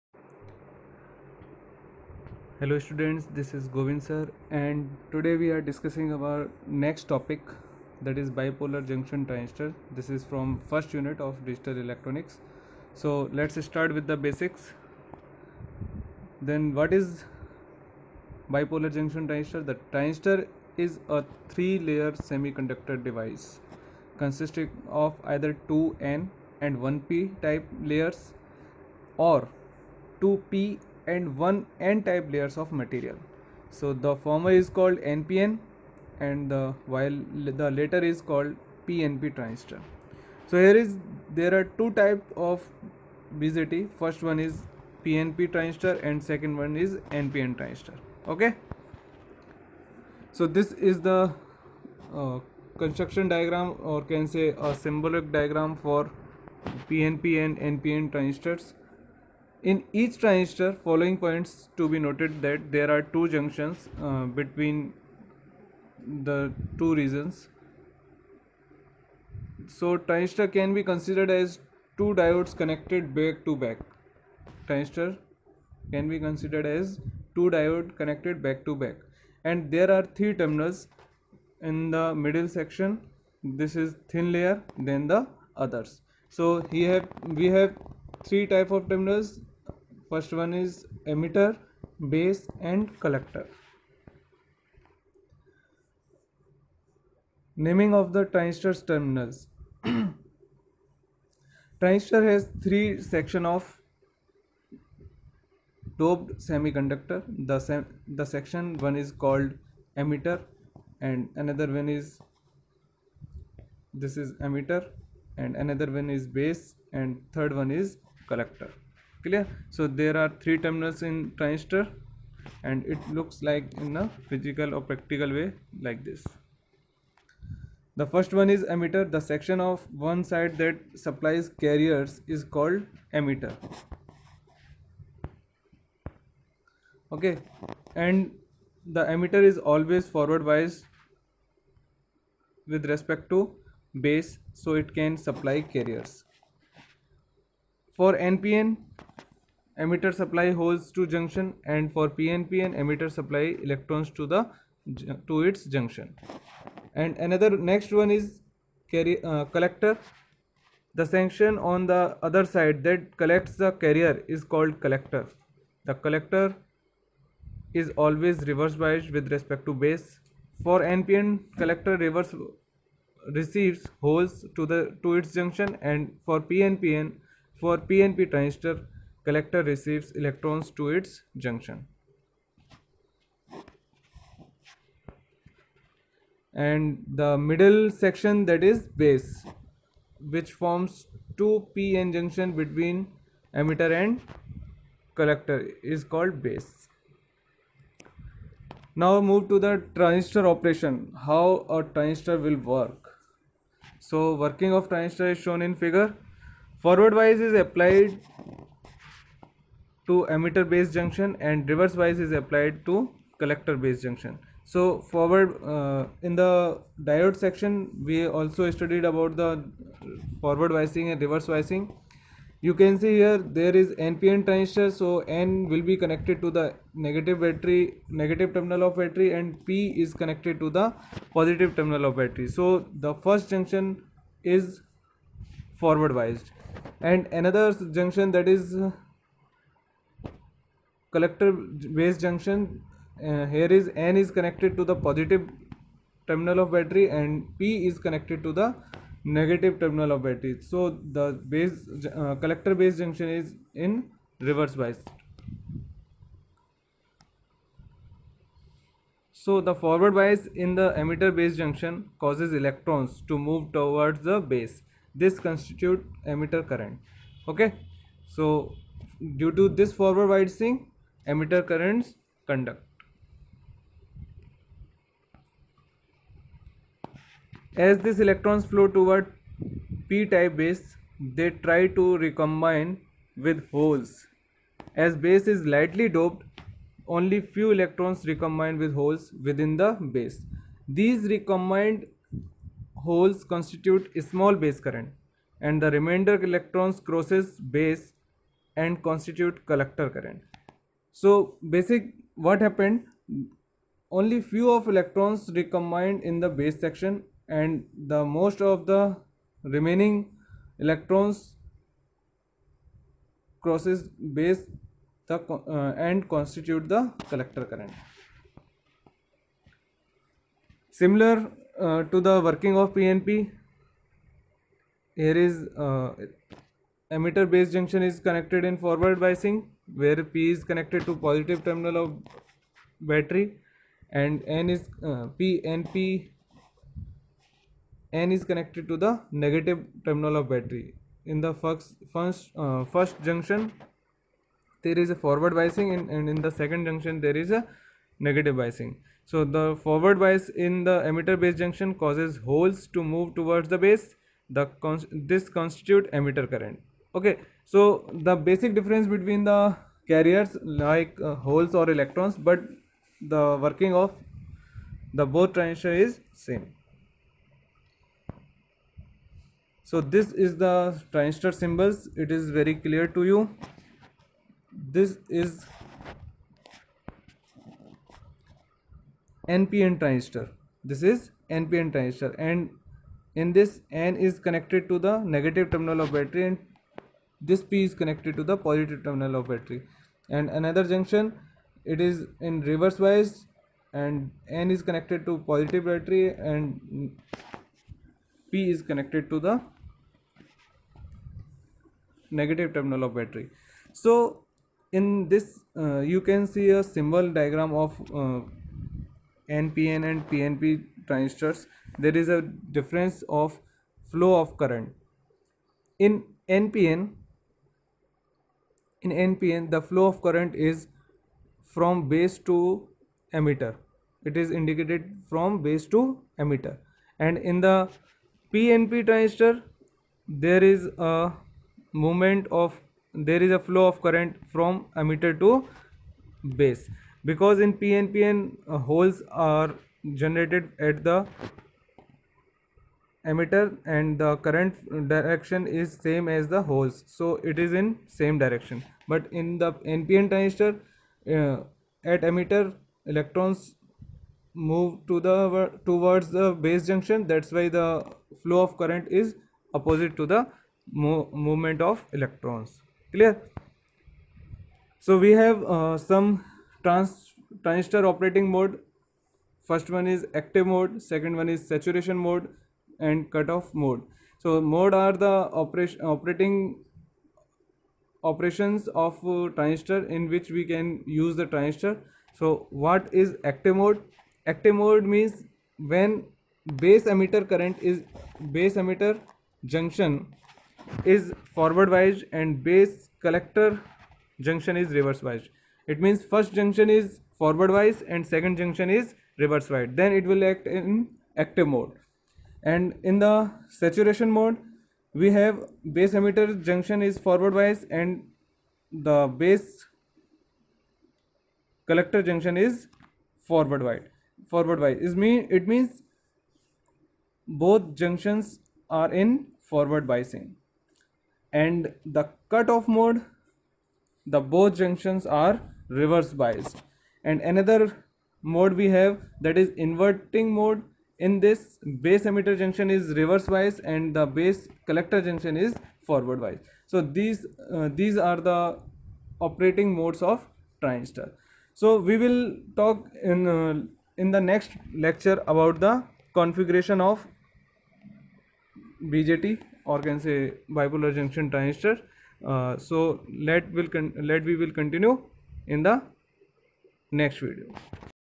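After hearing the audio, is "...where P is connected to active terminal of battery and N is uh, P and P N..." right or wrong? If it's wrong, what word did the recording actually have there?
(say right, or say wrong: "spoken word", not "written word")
wrong: "positive", not "active".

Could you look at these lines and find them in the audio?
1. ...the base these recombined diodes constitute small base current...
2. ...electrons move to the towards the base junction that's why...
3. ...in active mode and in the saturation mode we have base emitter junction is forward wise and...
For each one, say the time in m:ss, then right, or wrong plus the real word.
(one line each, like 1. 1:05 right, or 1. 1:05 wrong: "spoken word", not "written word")
1. 4:49 wrong: "holes", not "diodes"
2. 7:33 right
3. 8:20 right.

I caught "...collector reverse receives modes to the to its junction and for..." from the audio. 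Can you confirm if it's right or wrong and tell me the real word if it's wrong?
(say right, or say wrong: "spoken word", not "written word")
wrong: "holes", not "modes".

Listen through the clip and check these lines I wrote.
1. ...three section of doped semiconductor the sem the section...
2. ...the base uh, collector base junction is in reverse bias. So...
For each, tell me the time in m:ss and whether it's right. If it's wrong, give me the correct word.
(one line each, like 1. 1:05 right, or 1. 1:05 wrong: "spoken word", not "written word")
1. 1:42 right
2. 4:11 right.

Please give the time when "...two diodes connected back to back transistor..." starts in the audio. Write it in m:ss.
1:11.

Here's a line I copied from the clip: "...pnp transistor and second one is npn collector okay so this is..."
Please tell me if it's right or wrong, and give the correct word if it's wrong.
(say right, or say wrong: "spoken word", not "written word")
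wrong: "transistor", not "collector".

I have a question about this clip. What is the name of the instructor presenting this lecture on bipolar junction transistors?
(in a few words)
Govind sir.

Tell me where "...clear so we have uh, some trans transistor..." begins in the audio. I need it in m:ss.
7:43.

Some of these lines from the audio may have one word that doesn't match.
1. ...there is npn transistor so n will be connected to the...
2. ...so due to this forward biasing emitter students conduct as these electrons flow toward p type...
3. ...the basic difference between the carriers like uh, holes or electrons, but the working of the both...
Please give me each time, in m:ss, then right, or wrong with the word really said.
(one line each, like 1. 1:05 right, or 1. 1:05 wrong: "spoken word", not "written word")
1. 3:43 right
2. 4:28 wrong: "currents", not "students"
3. 5:58 right.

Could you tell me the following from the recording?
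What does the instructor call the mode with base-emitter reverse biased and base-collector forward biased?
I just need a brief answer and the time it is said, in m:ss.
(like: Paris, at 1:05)
Inverting mode, at 8:49.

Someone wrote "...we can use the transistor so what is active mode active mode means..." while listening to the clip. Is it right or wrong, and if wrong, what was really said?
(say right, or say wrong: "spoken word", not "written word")
right.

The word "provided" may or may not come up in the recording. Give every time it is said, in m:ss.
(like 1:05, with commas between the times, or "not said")
not said.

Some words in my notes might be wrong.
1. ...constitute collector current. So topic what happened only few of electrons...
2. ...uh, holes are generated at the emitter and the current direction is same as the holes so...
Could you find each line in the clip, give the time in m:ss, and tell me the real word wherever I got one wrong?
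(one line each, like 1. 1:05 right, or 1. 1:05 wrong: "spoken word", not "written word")
1. 4:59 wrong: "basic", not "topic"
2. 7:18 right.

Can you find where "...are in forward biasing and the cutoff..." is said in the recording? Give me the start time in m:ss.
8:38.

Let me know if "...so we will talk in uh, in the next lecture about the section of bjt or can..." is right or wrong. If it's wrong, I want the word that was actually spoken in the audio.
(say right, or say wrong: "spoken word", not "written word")
wrong: "configuration", not "section".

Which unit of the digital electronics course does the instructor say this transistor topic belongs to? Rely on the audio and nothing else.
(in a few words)
First unit.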